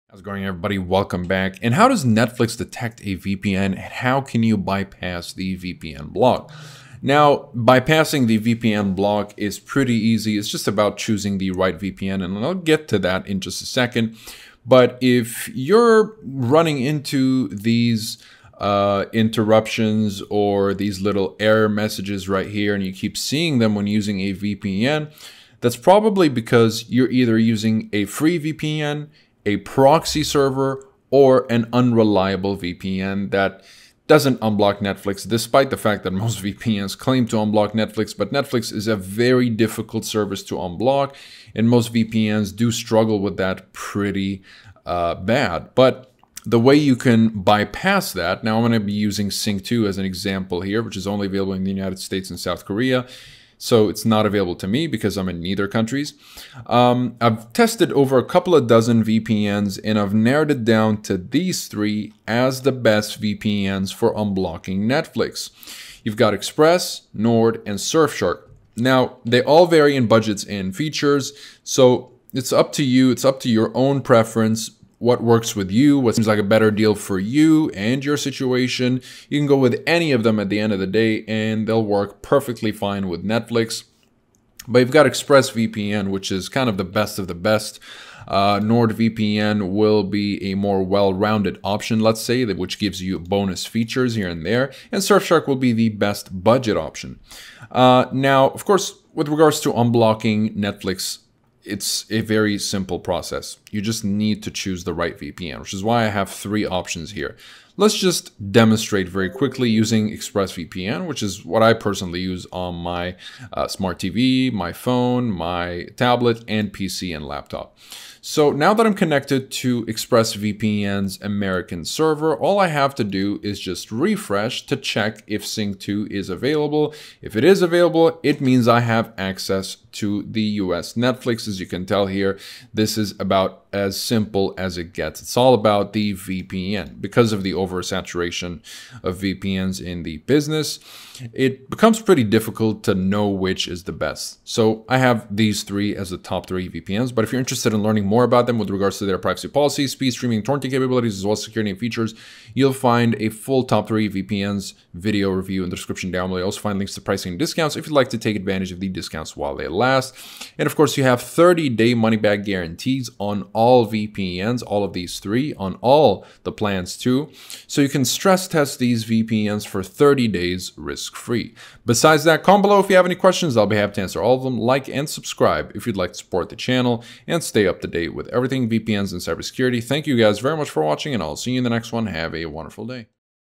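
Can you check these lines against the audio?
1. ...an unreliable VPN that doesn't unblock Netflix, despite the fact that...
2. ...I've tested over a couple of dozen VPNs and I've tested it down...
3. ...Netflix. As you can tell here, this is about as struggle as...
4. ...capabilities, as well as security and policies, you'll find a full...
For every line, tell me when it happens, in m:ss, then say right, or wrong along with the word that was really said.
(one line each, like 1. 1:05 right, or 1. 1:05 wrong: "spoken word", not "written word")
1. 0:31 right
2. 0:57 wrong: "narrowed", not "tested"
3. 2:10 wrong: "simple", not "struggle"
4. 2:30 wrong: "features", not "policies".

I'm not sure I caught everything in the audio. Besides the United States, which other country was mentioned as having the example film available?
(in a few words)
South Korea.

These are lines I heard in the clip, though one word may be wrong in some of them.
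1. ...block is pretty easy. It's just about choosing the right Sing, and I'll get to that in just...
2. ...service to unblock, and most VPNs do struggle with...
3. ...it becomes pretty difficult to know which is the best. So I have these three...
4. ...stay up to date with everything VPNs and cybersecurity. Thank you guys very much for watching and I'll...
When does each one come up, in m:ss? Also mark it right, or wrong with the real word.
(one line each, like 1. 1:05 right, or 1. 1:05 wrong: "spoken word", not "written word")
1. 0:08 wrong: "VPN", not "Sing"
2. 0:40 right
3. 2:21 right
4. 2:57 right.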